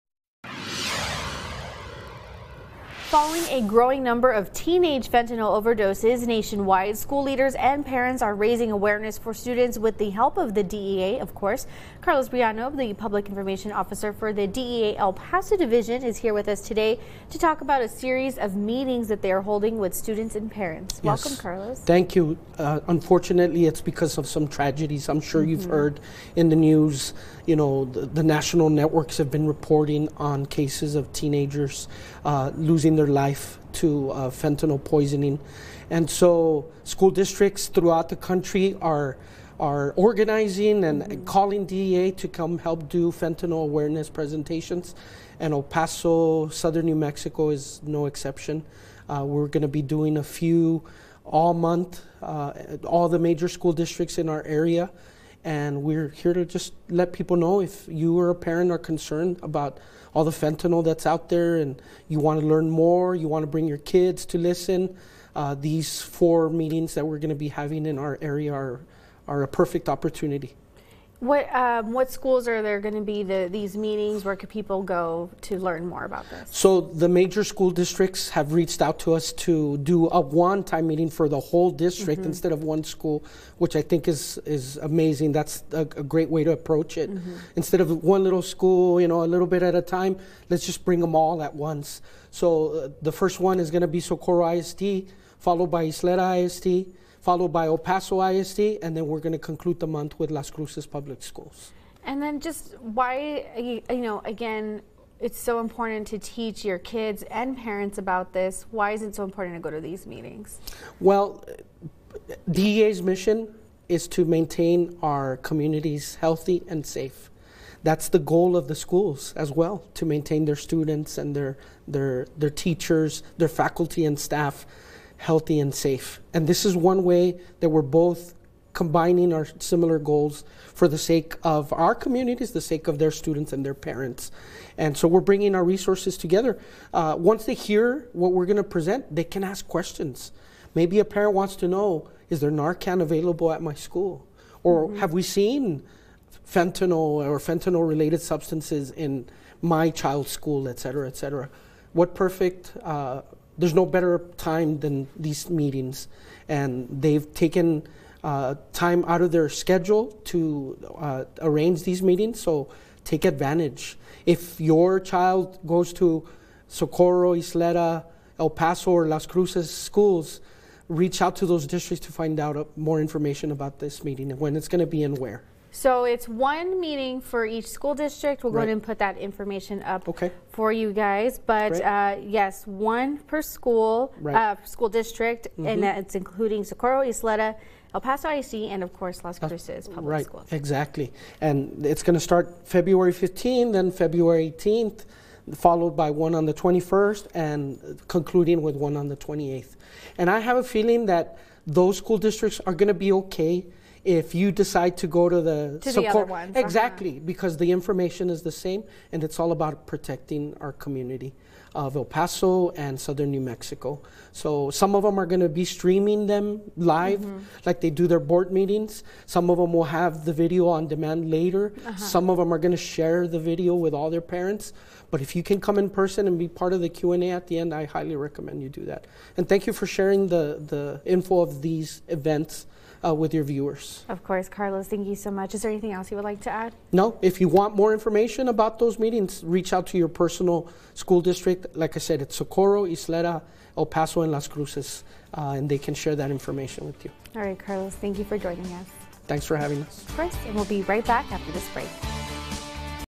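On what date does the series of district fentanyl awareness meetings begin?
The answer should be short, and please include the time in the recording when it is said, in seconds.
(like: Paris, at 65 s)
February 15, at 192 s.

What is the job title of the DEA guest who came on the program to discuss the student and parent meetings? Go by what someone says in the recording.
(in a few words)
Public information officer.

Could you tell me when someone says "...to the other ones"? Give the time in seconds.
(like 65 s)
205 s.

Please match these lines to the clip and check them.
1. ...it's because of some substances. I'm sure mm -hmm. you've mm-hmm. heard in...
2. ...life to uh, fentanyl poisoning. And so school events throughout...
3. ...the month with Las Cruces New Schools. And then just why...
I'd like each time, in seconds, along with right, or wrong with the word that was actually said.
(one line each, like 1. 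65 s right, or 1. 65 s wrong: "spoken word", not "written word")
1. 23 s wrong: "tragedies", not "substances"
2. 33 s wrong: "districts", not "events"
3. 99 s wrong: "Public", not "New".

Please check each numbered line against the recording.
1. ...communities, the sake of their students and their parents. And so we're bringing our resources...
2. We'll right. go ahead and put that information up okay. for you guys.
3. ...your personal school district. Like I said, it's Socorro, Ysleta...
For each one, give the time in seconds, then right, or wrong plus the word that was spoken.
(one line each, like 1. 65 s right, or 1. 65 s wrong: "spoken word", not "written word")
1. 131 s right
2. 178 s right
3. 239 s right.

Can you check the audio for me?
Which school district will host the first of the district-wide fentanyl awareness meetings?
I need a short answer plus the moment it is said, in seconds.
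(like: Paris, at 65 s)
Socorro ISD, at 94 s.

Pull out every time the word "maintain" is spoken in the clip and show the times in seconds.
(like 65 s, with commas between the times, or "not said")
114 s, 120 s.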